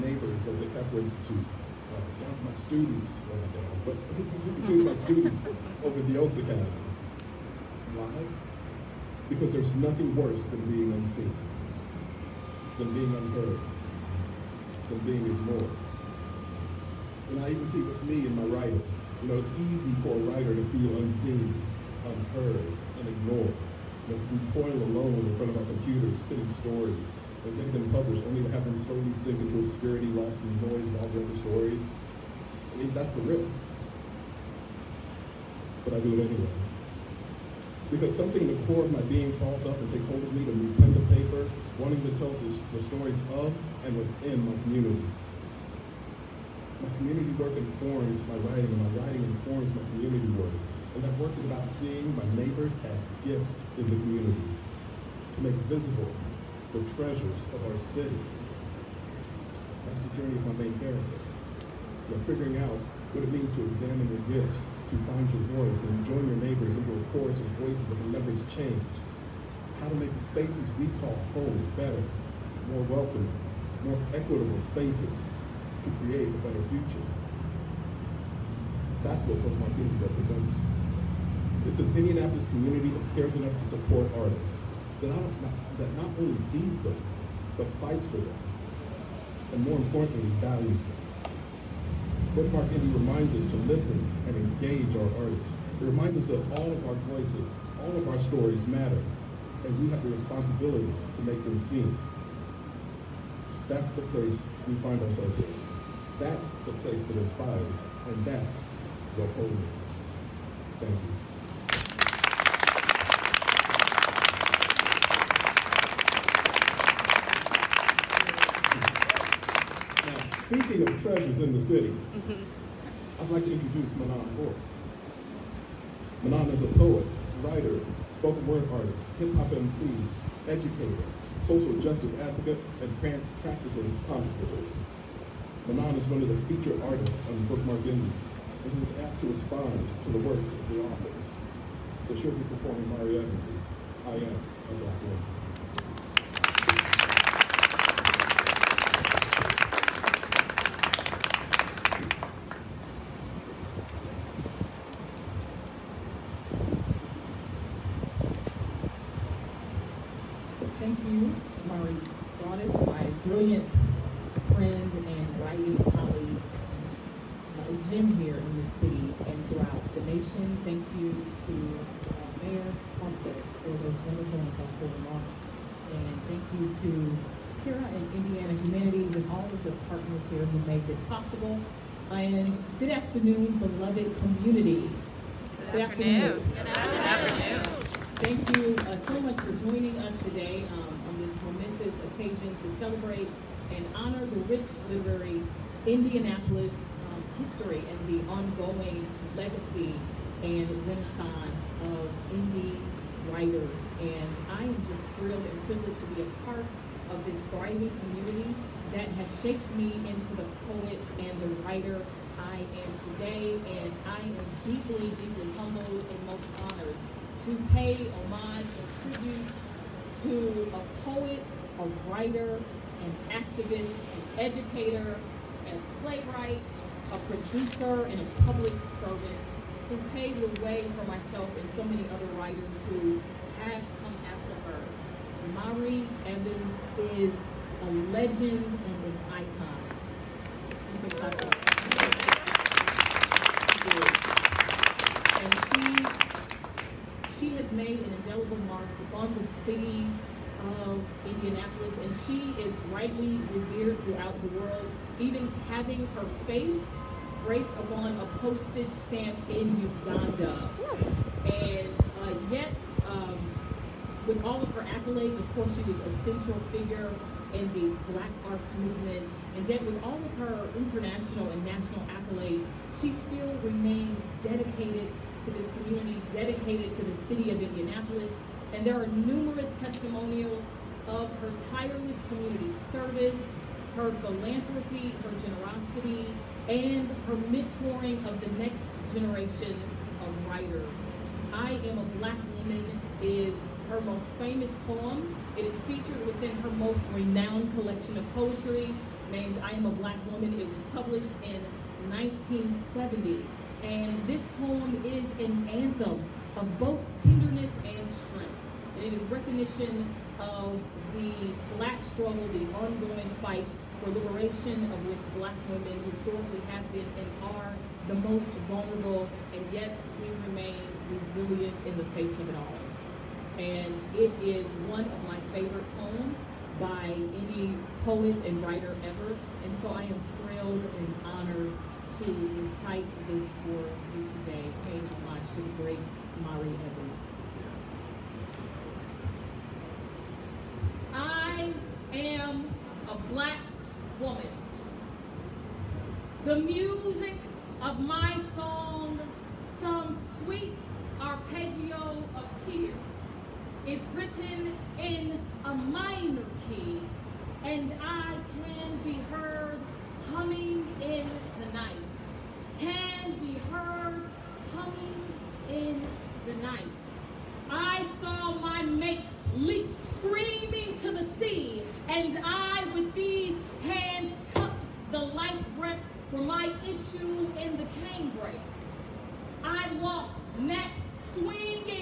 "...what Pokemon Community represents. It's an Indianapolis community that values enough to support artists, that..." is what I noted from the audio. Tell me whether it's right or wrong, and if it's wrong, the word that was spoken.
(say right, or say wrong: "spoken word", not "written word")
wrong: "cares", not "values".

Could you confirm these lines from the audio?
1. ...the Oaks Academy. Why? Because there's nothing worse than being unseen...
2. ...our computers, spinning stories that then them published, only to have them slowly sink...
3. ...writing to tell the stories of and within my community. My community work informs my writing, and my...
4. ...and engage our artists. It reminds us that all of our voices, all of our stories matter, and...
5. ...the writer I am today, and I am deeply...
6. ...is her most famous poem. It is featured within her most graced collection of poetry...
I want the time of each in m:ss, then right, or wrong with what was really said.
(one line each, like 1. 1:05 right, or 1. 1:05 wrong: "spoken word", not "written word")
1. 0:06 right
2. 0:25 right
3. 0:41 wrong: "wanting", not "writing"
4. 1:34 right
5. 3:31 right
6. 4:53 wrong: "renowned", not "graced".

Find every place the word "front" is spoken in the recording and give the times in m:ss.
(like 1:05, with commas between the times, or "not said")
0:25.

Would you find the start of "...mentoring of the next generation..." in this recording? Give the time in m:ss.
4:47.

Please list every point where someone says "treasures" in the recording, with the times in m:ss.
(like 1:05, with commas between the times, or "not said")
0:56, 2:01.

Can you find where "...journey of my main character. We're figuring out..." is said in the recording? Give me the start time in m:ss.
1:00.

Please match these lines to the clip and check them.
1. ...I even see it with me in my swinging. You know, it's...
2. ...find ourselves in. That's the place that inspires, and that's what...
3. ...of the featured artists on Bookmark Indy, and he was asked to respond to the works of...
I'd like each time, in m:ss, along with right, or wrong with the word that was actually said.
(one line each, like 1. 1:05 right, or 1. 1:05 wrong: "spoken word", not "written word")
1. 0:17 wrong: "writing", not "swinging"
2. 1:44 right
3. 2:16 right.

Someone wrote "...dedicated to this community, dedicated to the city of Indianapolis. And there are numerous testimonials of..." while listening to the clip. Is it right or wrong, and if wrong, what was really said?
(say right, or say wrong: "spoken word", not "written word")
right.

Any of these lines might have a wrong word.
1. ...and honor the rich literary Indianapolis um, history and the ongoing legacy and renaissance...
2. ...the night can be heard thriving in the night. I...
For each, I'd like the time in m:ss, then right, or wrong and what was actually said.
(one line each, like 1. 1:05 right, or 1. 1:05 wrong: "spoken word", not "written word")
1. 3:13 right
2. 6:01 wrong: "humming", not "thriving".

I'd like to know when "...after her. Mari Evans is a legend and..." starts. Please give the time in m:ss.
3:54.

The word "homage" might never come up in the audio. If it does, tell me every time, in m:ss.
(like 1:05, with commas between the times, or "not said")
3:38, 5:35.